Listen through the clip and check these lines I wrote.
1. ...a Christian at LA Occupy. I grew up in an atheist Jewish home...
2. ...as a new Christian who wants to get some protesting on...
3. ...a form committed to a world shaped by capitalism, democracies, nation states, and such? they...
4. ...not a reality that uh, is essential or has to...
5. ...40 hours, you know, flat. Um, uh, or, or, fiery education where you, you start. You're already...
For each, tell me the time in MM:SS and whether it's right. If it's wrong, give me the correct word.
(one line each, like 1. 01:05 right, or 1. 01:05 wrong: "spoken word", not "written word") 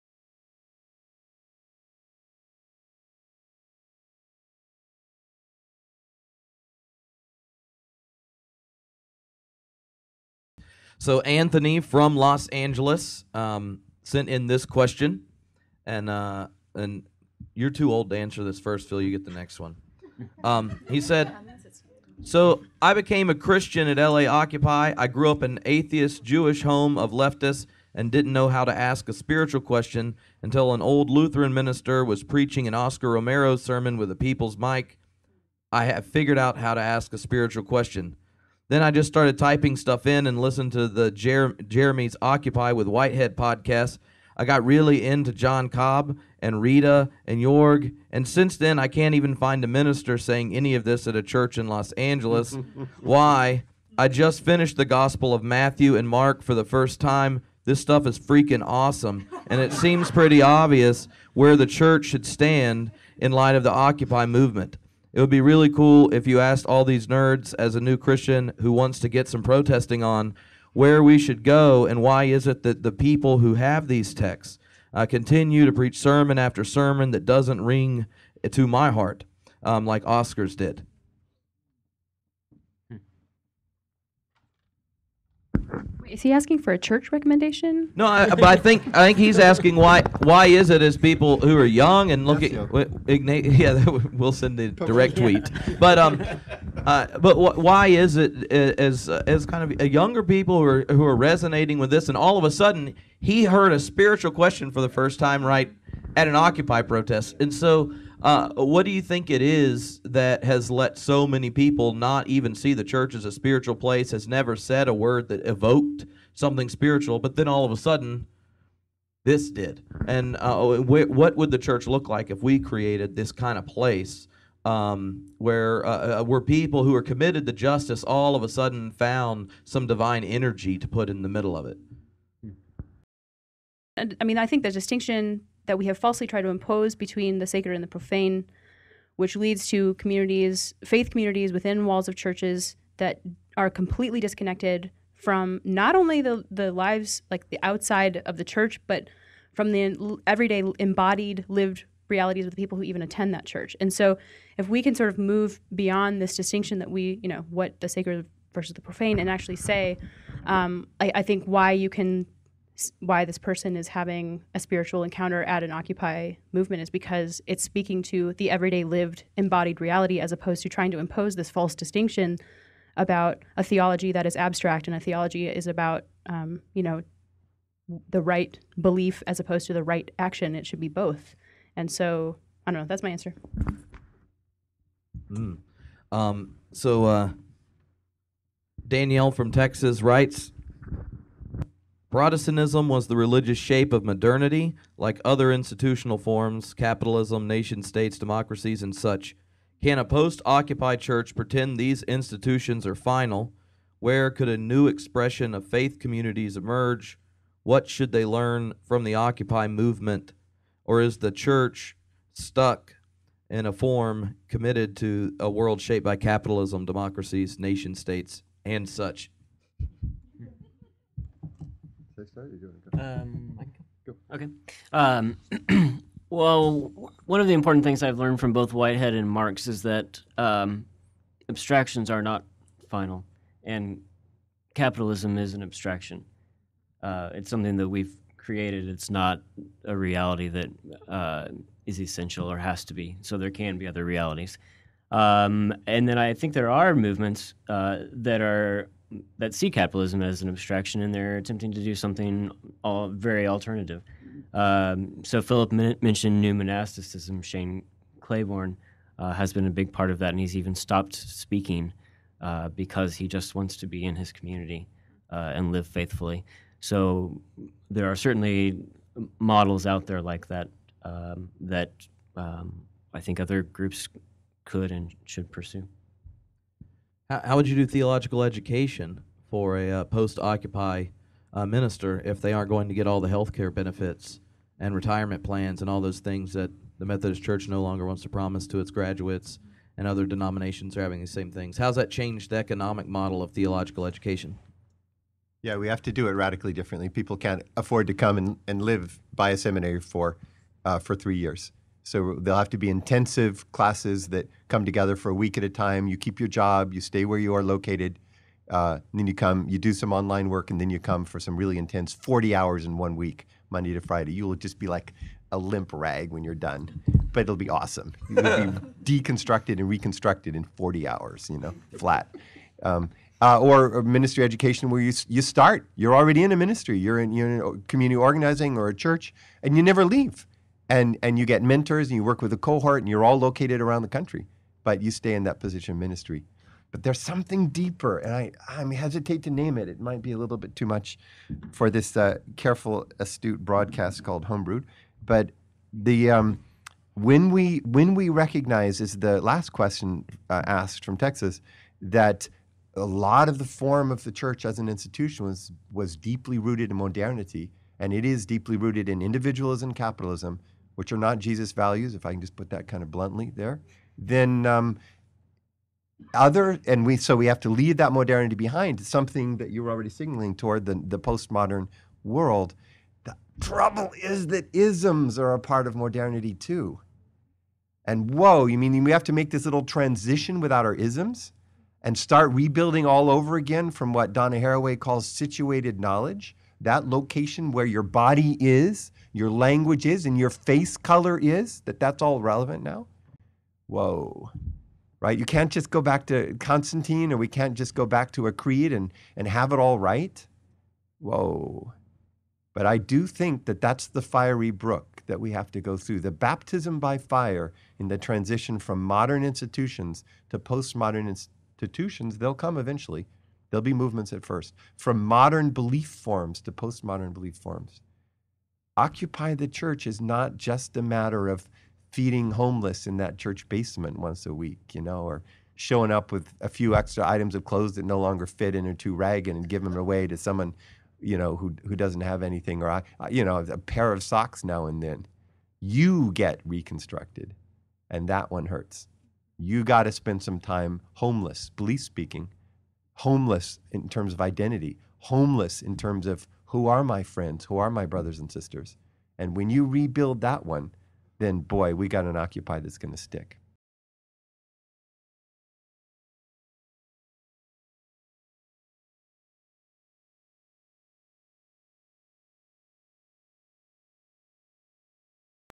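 1. 00:23 right
2. 01:07 right
3. 03:33 right
4. 03:59 right
5. 05:20 wrong: "ministry", not "fiery".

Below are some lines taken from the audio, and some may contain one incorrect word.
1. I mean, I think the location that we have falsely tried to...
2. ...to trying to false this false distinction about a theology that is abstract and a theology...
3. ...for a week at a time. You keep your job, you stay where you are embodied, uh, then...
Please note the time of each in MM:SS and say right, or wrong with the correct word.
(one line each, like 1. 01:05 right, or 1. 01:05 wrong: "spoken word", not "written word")
1. 02:14 wrong: "distinction", not "location"
2. 02:50 wrong: "impose", not "false"
3. 05:05 wrong: "located", not "embodied".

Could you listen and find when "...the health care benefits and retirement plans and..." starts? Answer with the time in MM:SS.
04:43.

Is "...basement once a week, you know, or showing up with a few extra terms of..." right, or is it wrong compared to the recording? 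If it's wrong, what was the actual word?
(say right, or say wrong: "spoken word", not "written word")
wrong: "items", not "terms".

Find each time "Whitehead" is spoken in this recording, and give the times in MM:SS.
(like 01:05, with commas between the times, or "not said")
00:42, 03:48.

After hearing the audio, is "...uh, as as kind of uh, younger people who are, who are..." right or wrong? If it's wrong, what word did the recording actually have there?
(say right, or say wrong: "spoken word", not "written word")
right.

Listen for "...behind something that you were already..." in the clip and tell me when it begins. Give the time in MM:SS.
06:08.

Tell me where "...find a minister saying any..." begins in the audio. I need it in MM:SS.
00:49.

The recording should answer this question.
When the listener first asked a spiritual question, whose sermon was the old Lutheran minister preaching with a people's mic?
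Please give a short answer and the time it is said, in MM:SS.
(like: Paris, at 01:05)
Oscar Romero, at 00:32.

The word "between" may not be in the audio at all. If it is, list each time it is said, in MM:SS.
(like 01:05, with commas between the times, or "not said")
02:16.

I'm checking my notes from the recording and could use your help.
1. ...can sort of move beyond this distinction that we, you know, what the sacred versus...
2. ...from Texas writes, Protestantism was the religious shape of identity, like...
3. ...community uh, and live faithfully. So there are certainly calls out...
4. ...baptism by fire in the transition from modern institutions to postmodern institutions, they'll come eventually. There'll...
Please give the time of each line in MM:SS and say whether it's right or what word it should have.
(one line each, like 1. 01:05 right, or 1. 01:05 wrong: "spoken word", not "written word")
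1. 02:34 right
2. 03:09 wrong: "modernity", not "identity"
3. 04:24 wrong: "models", not "calls"
4. 06:46 right.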